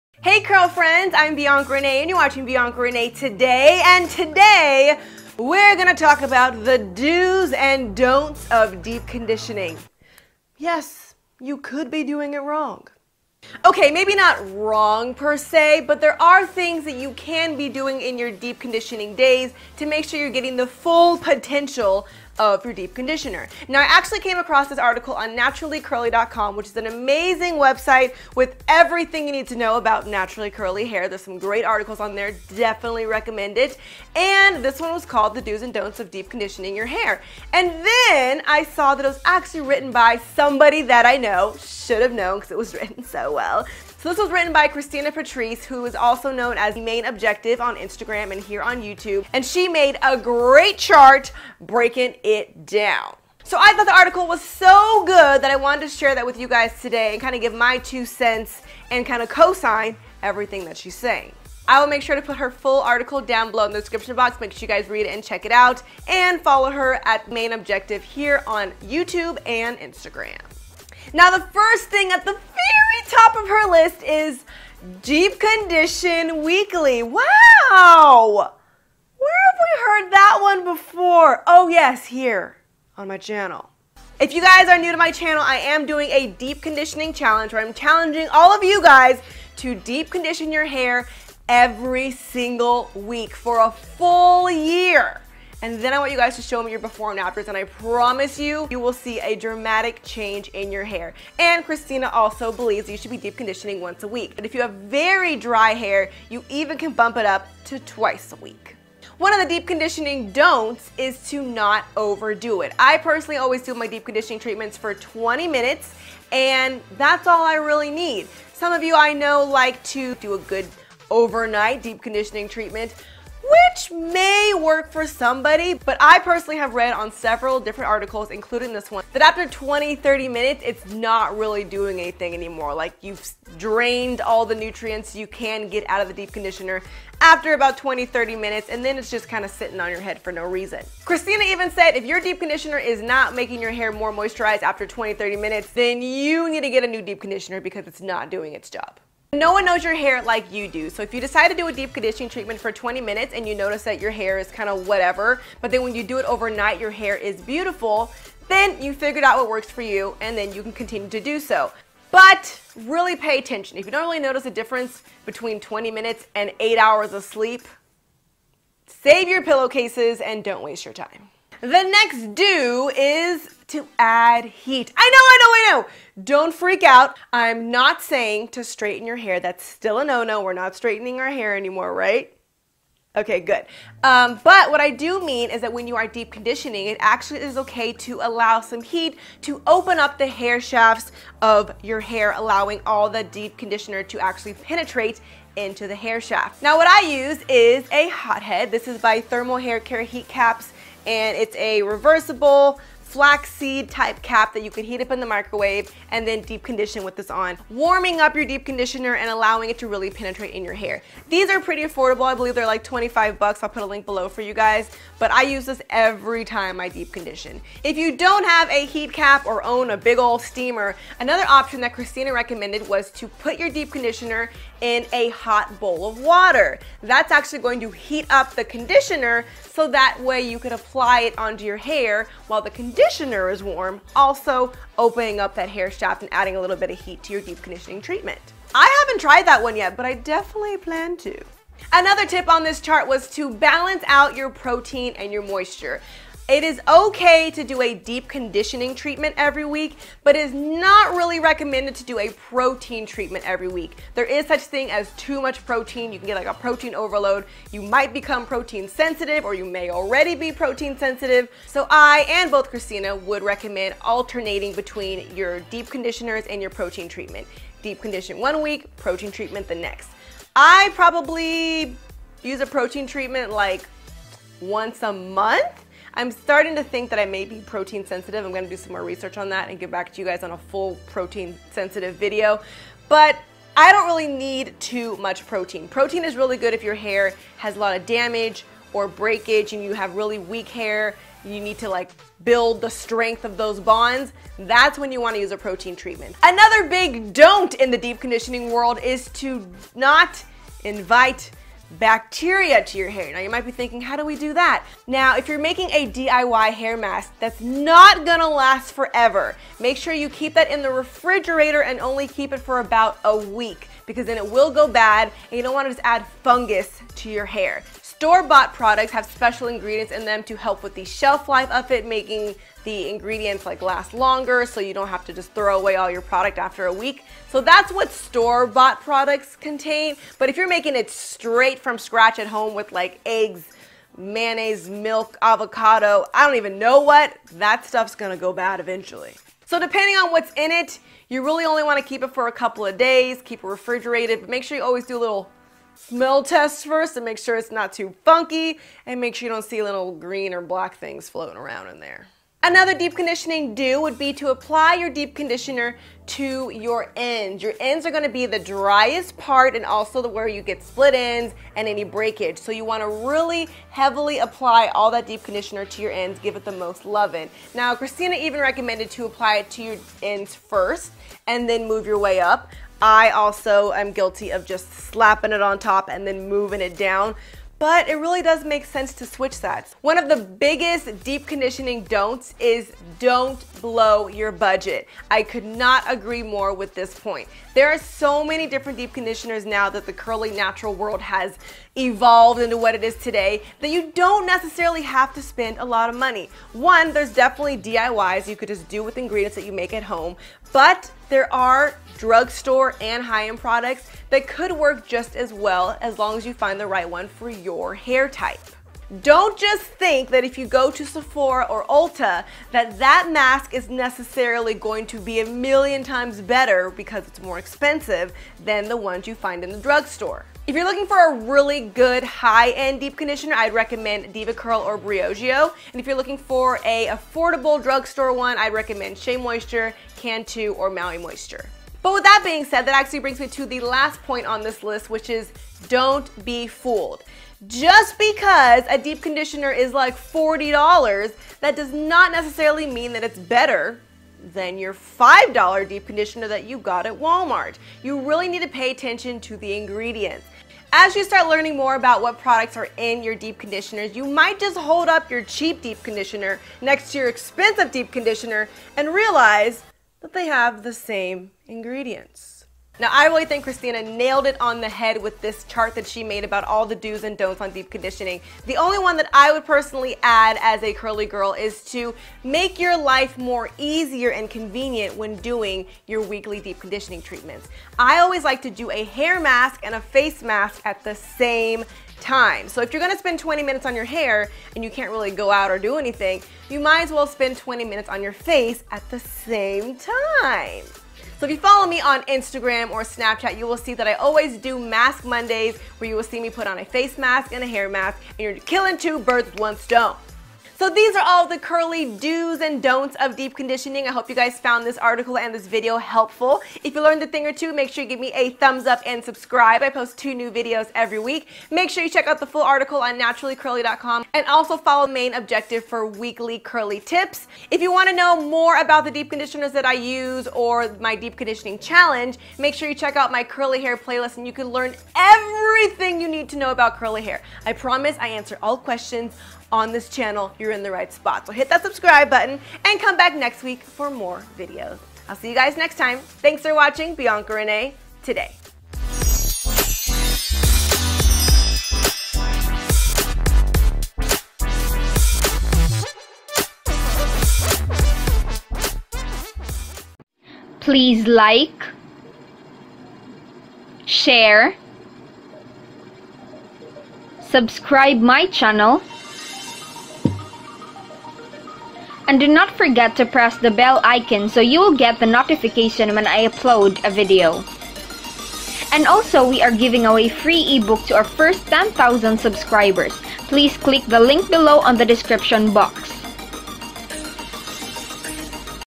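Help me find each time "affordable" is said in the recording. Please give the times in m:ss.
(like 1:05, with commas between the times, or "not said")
3:31, 7:07.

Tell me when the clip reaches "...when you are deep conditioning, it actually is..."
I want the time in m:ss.
3:05.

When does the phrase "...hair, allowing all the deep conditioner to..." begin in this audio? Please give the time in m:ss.
3:11.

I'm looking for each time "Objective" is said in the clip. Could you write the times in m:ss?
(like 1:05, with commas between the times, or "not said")
0:47, 1:07, 8:35.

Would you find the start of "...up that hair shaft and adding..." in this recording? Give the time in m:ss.
3:55.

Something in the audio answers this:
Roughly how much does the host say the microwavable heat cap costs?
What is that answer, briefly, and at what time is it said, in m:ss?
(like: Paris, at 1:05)
$25, at 3:32.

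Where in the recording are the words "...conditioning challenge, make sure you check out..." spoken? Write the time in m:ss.
8:41.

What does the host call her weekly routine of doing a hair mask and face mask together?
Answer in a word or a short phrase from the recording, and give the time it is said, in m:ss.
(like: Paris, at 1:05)
Mask Mondays, at 8:14.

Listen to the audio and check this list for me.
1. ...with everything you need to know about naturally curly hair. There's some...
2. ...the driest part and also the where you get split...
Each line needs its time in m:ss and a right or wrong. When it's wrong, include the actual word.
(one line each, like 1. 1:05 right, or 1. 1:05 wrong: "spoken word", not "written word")
1. 0:28 right
2. 5:58 right.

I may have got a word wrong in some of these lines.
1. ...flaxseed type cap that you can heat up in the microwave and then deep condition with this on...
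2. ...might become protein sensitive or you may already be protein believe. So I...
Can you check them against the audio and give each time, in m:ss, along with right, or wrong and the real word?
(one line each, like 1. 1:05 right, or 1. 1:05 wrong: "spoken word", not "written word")
1. 3:23 right
2. 4:17 wrong: "sensitive", not "believe".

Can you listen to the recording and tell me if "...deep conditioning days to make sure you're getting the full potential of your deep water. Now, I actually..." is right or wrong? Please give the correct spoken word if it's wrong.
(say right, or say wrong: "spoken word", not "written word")
wrong: "conditioner", not "water".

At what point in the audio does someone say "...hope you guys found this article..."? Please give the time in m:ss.
8:24.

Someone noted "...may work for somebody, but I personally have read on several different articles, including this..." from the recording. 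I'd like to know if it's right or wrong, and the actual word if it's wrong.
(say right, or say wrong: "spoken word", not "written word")
right.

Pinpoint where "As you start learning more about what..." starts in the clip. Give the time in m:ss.
7:30.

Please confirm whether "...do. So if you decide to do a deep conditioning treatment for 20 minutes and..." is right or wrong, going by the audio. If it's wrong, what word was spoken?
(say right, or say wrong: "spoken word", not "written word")
right.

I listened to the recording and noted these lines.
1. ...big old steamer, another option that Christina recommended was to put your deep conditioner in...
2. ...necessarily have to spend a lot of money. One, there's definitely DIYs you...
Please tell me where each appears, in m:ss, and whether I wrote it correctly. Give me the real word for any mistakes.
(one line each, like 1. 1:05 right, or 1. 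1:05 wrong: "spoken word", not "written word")
1. 3:39 right
2. 6:34 right.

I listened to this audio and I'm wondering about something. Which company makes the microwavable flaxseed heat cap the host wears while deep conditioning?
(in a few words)
Thermal Hair Care.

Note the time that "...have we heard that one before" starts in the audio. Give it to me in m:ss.
1:19.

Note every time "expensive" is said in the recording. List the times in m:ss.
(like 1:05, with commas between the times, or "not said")
6:57, 7:37.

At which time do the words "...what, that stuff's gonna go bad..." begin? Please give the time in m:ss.
5:36.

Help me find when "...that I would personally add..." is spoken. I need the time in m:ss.
7:49.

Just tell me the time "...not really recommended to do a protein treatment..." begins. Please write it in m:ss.
4:10.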